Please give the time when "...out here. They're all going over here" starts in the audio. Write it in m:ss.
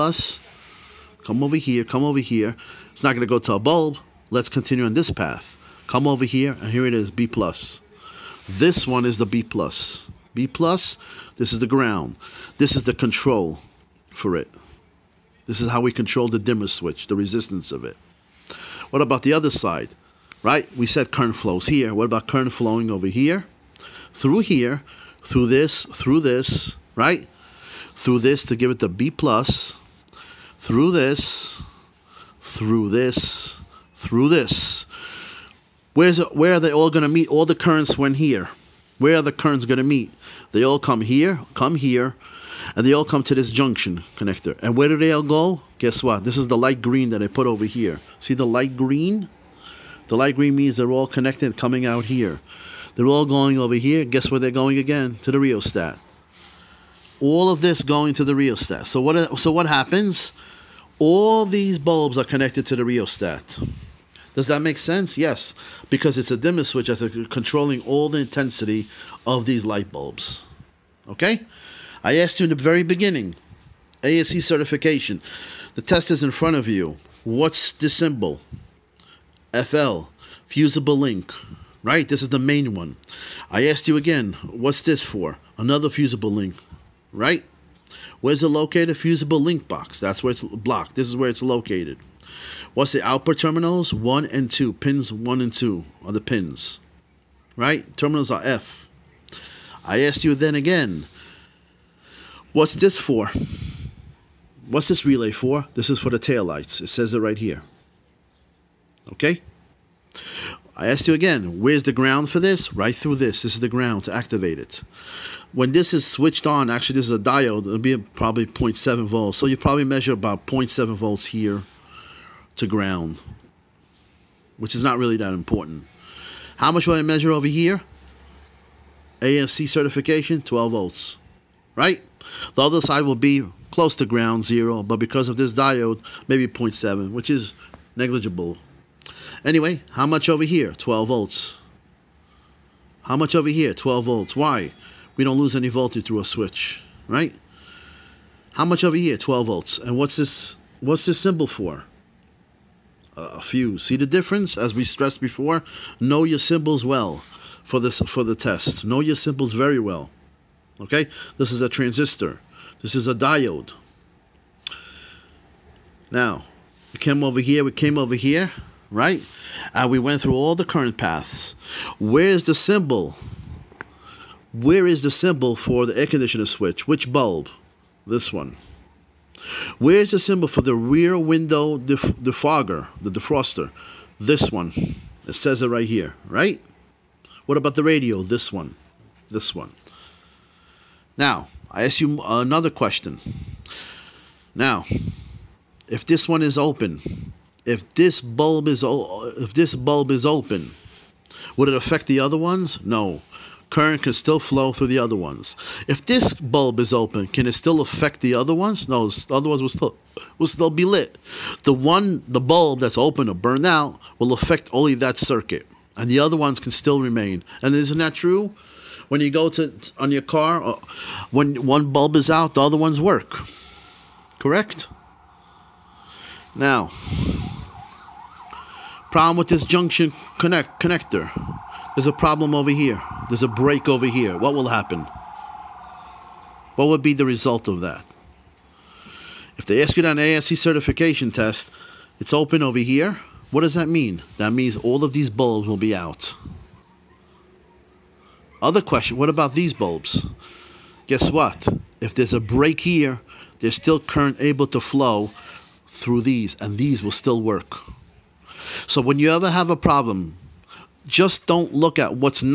0:51.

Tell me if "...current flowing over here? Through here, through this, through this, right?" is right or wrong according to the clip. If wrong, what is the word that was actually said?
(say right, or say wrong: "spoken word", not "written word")
right.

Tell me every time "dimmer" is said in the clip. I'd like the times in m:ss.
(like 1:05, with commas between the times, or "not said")
0:16, 1:06.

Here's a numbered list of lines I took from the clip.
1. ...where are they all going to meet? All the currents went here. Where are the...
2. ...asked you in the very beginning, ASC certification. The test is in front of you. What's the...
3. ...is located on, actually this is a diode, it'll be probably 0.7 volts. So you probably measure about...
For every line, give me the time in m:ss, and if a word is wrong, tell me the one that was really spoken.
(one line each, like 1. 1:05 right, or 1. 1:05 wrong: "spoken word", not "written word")
1. 0:36 right
2. 1:12 right
3. 1:55 wrong: "switched", not "located".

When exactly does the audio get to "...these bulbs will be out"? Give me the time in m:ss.
4:05.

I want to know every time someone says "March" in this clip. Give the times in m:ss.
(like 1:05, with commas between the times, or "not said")
not said.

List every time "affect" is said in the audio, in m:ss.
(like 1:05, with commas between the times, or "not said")
3:21, 3:27, 3:34.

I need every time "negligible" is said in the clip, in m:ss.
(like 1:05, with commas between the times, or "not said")
2:17.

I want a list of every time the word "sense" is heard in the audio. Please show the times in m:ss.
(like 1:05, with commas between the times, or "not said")
1:04.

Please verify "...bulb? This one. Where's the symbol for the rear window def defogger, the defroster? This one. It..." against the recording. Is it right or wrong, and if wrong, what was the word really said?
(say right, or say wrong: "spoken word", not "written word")
right.